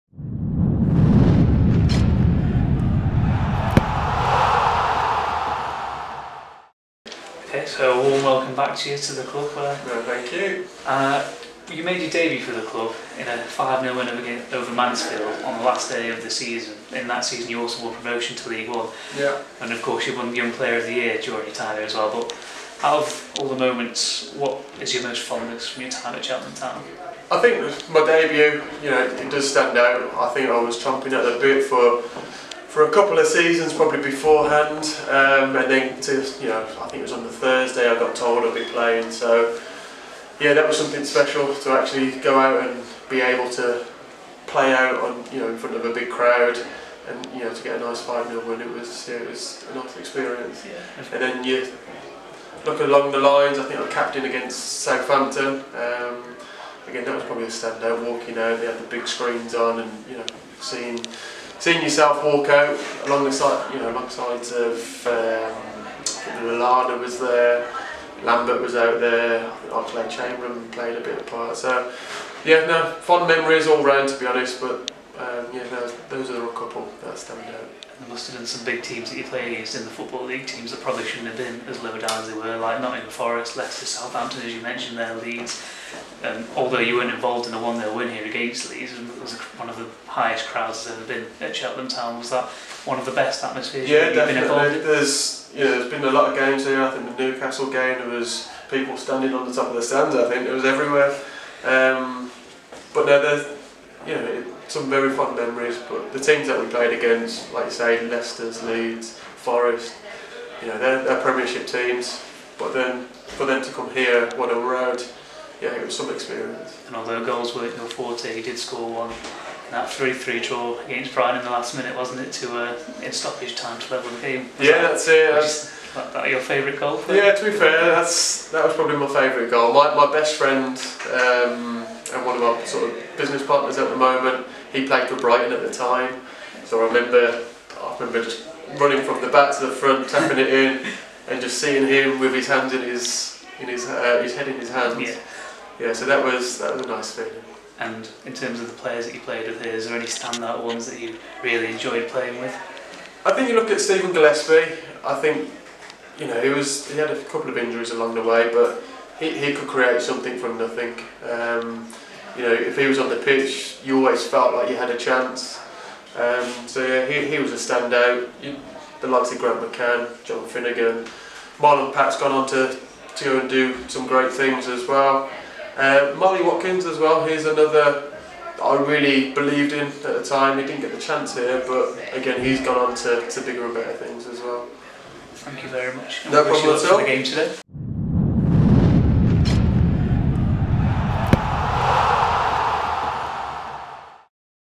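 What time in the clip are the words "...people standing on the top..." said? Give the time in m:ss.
1:38.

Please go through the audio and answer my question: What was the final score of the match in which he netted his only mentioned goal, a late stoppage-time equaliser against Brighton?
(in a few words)
3-3.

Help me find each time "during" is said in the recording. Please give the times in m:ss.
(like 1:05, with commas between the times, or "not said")
0:21.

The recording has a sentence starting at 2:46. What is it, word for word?
Um, so yeah, he, he was a standout.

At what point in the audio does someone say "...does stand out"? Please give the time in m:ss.
0:29.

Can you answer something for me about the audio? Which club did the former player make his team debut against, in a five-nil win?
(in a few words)
Mansfield.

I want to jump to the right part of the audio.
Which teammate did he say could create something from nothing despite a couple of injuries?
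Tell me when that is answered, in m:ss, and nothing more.
2:33.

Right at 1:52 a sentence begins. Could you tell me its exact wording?
But then for them to come here, what a road yeah, it was some experience.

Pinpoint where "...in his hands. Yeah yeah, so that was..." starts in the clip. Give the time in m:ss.
2:24.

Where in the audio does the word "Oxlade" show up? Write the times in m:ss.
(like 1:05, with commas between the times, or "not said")
1:09.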